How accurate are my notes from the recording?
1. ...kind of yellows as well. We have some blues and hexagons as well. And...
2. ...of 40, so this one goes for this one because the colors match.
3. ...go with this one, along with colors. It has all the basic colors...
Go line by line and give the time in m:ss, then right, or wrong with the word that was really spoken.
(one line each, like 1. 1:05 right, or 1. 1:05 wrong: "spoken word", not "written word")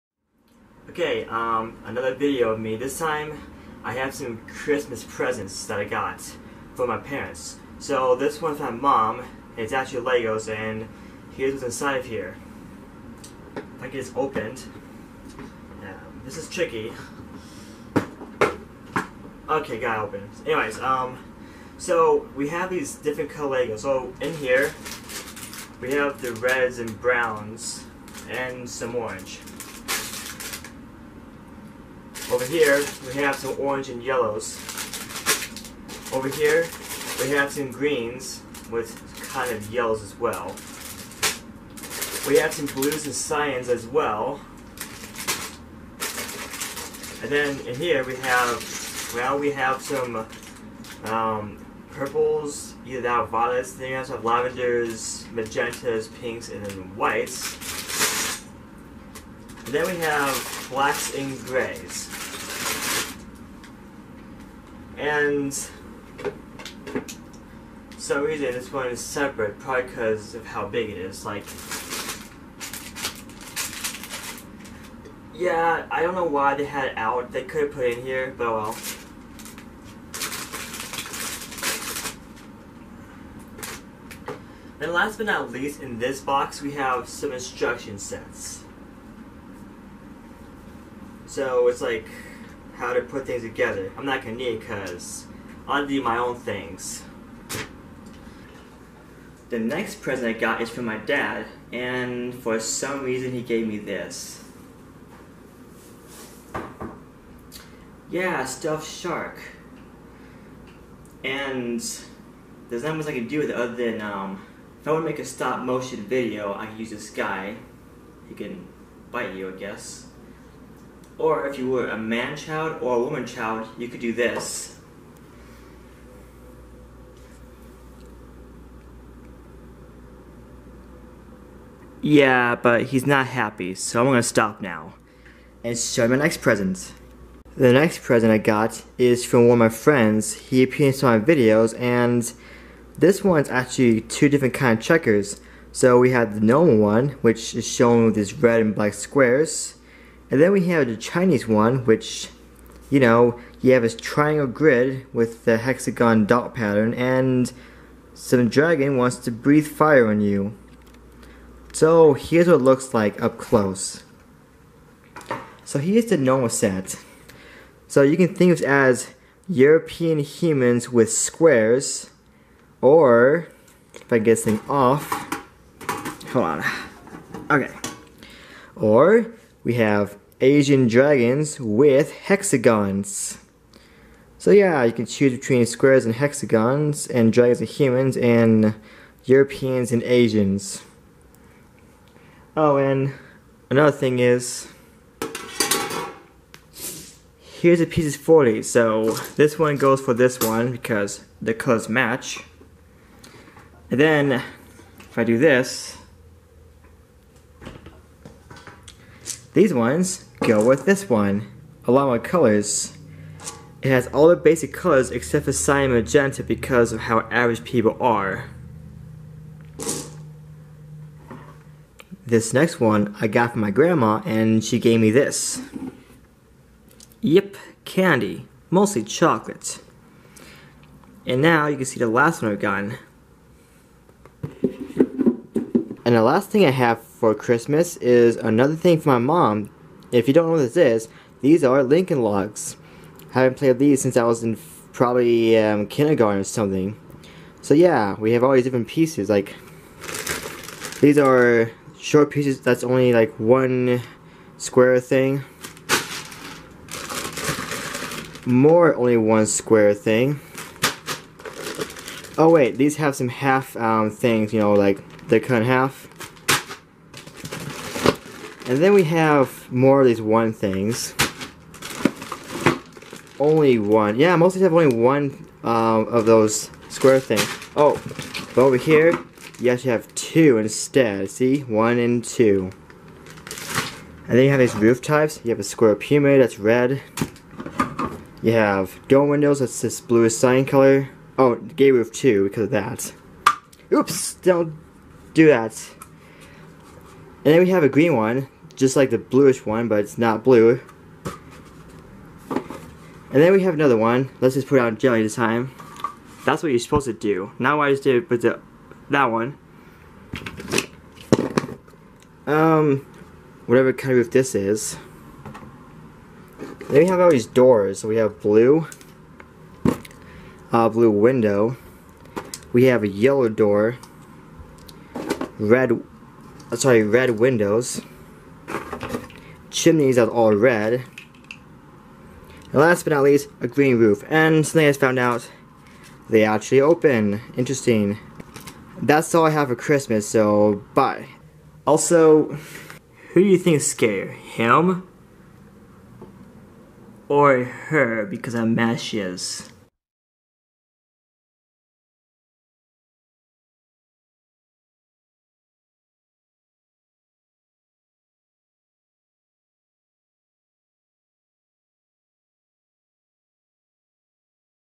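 1. 0:39 wrong: "cyans", not "hexagons"
2. 3:18 right
3. 3:30 right.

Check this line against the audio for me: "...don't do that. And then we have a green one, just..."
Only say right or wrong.
right.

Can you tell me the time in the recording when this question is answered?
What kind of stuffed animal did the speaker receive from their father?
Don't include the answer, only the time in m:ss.
1:48.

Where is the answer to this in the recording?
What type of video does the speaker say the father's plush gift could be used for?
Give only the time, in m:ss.
1:55.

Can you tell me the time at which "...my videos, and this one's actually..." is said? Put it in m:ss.
2:21.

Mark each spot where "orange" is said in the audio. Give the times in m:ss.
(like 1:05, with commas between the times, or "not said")
0:28, 0:33.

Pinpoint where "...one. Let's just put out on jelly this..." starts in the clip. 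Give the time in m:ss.
5:03.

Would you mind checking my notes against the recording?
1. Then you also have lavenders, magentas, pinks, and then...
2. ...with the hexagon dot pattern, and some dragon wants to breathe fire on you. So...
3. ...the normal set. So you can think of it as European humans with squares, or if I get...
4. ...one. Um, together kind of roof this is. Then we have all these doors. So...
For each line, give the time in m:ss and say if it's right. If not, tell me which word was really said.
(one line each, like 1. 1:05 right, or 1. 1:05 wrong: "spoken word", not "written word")
1. 0:53 right
2. 2:35 right
3. 2:46 right
4. 5:09 wrong: "whatever", not "together".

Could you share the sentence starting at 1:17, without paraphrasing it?
They could have put it in here, but oh well.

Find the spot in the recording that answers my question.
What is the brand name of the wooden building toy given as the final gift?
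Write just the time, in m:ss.
4:01.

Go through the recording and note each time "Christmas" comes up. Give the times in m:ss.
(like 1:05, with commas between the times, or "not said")
0:04, 3:57, 5:39.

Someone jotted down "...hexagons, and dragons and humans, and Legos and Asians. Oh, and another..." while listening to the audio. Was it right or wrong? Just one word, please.
wrong.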